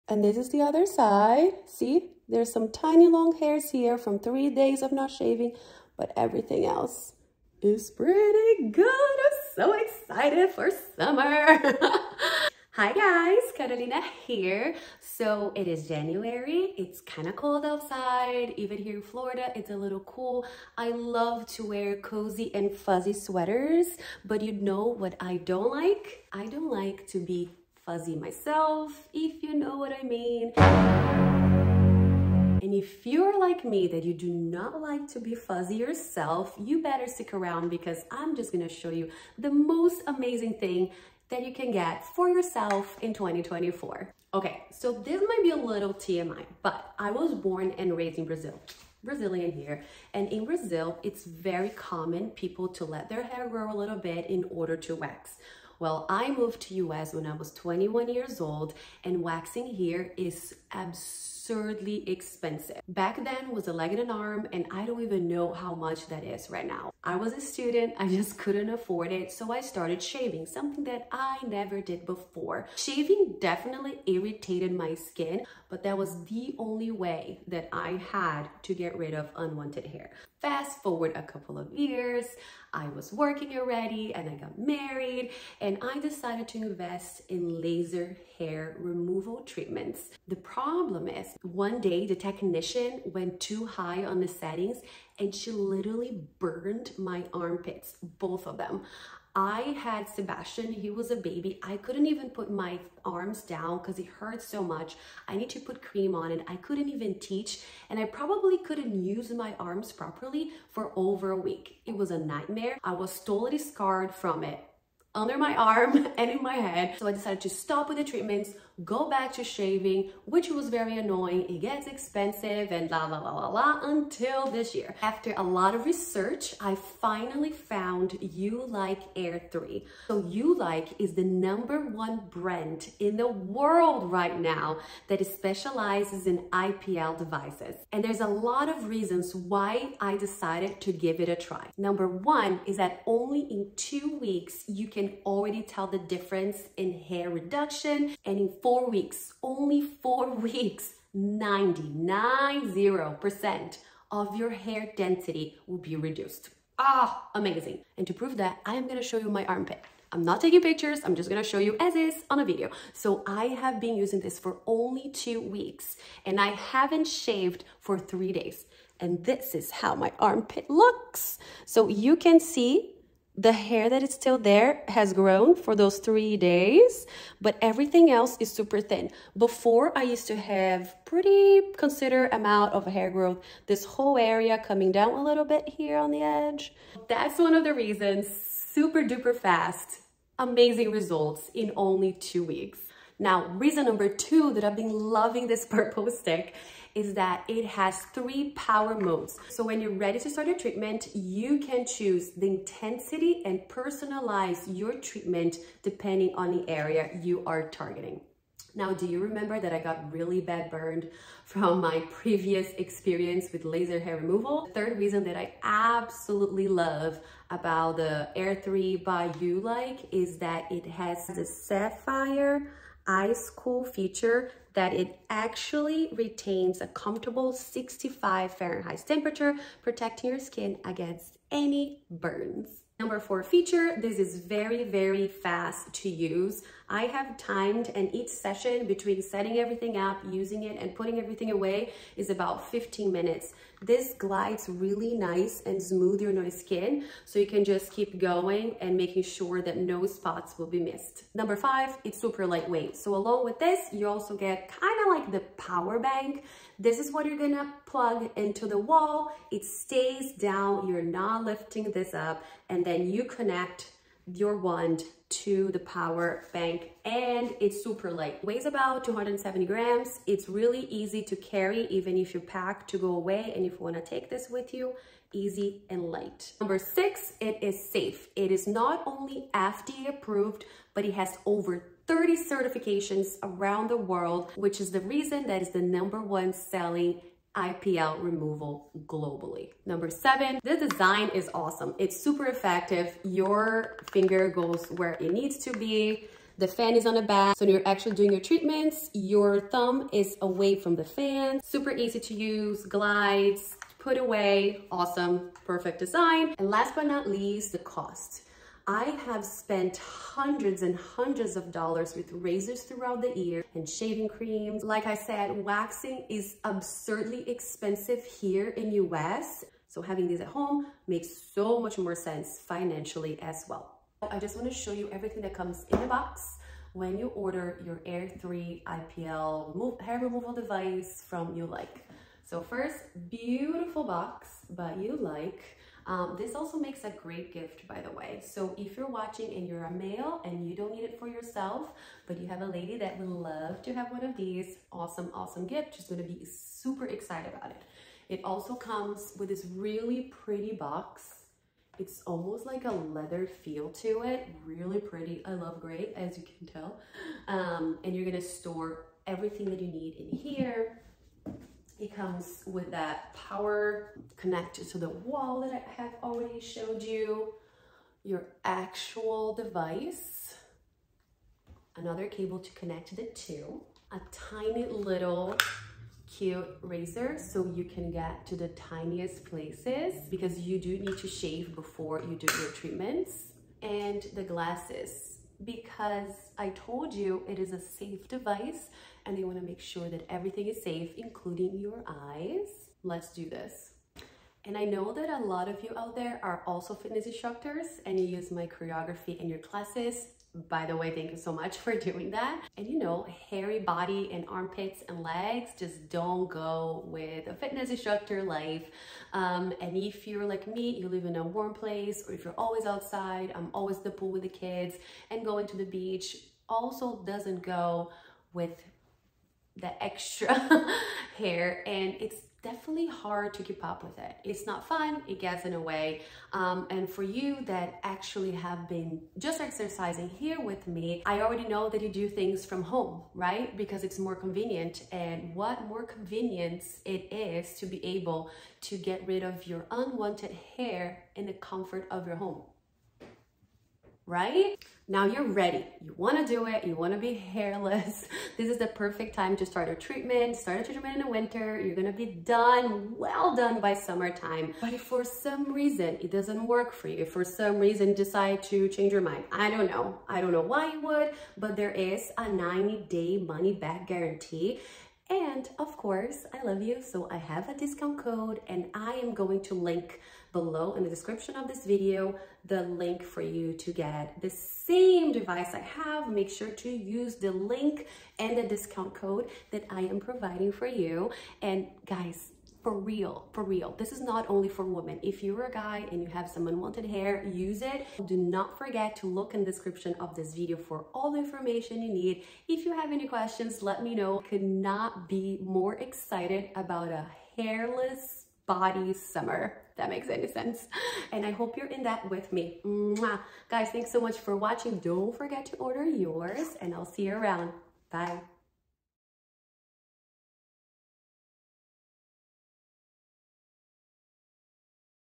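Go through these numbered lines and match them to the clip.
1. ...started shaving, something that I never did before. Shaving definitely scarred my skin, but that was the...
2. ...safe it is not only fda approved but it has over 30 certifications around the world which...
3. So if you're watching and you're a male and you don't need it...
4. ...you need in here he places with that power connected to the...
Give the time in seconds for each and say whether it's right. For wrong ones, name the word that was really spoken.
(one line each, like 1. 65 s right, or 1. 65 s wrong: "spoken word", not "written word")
1. 69 s wrong: "irritated", not "scarred"
2. 277 s right
3. 338 s right
4. 359 s wrong: "comes", not "places".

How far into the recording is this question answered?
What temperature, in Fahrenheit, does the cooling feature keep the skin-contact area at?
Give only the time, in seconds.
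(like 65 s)
227 s.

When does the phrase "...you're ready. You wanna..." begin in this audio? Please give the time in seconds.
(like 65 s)
445 s.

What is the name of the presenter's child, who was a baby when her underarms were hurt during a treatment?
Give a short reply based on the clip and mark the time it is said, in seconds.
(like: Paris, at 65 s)
Sebastian, at 100 s.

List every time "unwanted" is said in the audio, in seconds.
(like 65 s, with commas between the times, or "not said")
79 s, 439 s, 486 s.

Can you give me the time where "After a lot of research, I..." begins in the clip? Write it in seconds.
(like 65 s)
125 s.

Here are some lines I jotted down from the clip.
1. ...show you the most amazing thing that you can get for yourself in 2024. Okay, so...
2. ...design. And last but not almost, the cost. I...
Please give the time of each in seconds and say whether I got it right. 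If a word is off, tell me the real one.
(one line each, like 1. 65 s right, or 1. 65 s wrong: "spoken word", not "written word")
1. 38 s right
2. 305 s wrong: "least", not "almost".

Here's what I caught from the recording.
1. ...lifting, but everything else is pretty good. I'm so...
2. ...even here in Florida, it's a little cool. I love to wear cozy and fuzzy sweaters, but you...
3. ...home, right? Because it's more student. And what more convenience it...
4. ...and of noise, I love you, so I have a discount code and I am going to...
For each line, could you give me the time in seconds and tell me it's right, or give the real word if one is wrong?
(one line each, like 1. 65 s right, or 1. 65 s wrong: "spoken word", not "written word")
1. 5 s wrong: "shaving", not "lifting"
2. 18 s right
3. 432 s wrong: "convenient", not "student"
4. 465 s wrong: "course", not "noise".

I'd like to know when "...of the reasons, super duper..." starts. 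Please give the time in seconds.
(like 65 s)
187 s.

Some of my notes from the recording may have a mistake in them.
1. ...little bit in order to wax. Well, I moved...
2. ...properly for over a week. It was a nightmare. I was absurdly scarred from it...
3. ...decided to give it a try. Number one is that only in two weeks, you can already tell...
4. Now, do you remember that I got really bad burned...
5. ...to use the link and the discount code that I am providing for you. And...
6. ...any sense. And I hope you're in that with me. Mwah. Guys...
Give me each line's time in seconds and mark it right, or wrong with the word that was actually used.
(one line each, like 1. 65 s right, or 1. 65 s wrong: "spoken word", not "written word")
1. 53 s right
2. 109 s wrong: "totally", not "absurdly"
3. 140 s right
4. 208 s right
5. 476 s right
6. 500 s right.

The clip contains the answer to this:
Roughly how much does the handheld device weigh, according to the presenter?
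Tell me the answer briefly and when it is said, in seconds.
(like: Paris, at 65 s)
270 grams, at 269 s.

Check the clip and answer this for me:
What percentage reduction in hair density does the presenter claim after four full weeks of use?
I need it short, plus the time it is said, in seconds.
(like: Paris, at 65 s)
99%, at 151 s.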